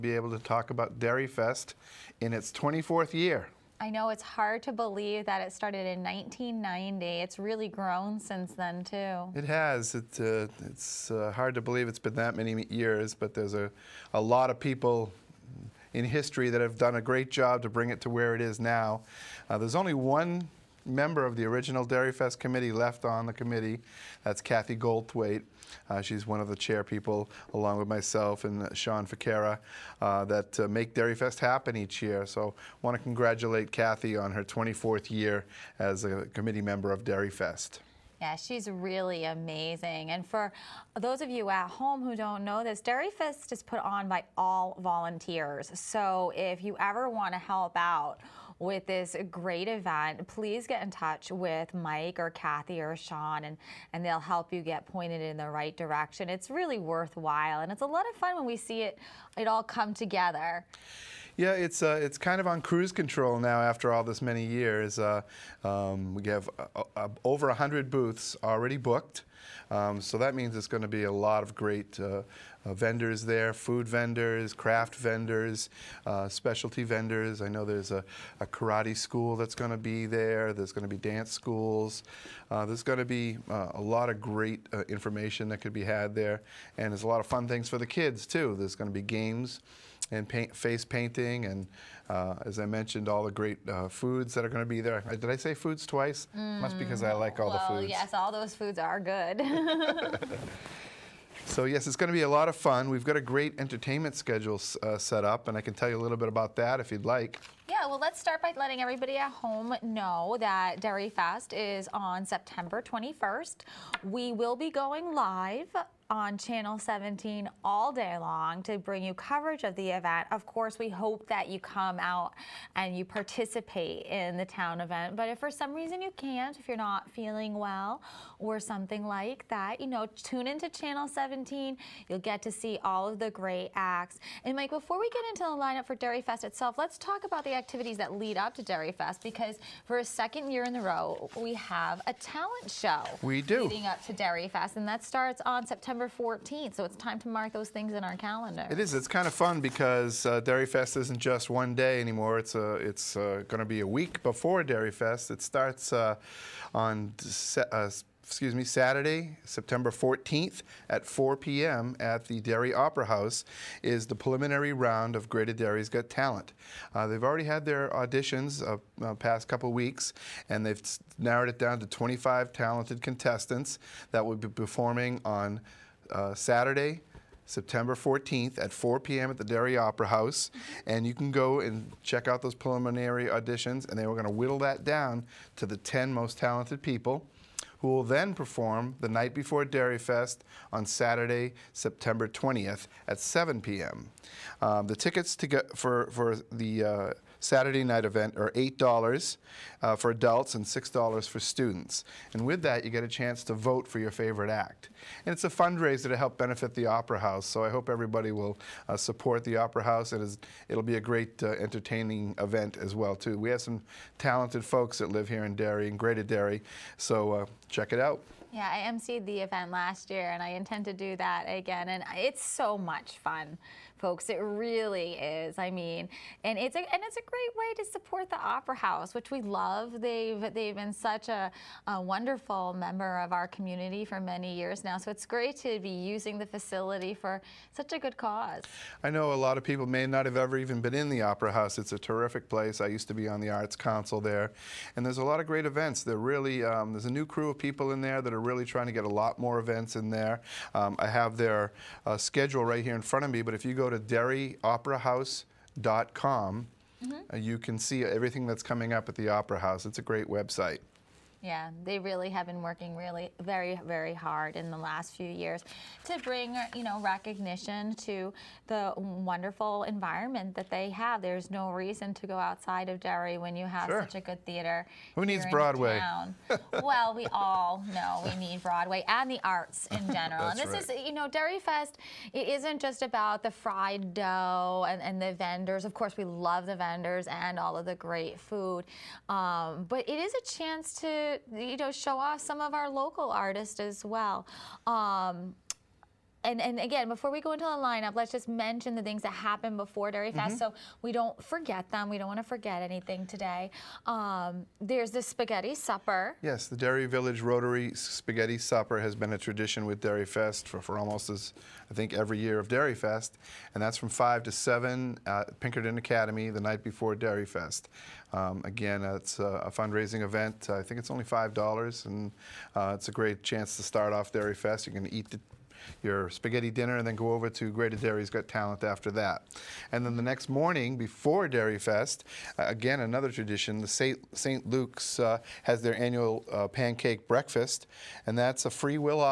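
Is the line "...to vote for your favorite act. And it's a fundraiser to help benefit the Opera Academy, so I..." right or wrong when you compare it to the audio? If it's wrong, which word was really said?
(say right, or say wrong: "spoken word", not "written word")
wrong: "House", not "Academy".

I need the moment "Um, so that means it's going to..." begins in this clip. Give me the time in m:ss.
1:09.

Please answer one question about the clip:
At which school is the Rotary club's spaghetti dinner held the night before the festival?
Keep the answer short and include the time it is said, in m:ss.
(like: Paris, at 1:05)
Pinkerton Academy, at 5:15.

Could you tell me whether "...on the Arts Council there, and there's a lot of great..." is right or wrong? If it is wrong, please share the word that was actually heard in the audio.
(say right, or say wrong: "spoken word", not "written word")
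right.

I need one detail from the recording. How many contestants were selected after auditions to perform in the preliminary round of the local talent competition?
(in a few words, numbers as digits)
25.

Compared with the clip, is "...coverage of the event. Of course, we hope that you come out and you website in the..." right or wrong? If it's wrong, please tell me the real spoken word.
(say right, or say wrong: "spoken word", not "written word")
wrong: "participate", not "website".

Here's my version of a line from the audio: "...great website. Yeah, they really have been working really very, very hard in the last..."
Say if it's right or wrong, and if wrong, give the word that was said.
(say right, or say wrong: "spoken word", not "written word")
right.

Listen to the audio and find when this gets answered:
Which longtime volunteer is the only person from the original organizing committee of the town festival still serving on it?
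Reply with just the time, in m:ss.
0:24.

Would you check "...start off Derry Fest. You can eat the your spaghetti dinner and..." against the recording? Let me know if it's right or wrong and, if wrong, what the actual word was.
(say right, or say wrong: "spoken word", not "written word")
right.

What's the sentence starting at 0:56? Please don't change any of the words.
It's really worthwhile and it's a lot of fun when we see it, it all come together.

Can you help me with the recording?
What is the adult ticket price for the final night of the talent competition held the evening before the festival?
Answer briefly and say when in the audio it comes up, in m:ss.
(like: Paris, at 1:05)
$8, at 3:18.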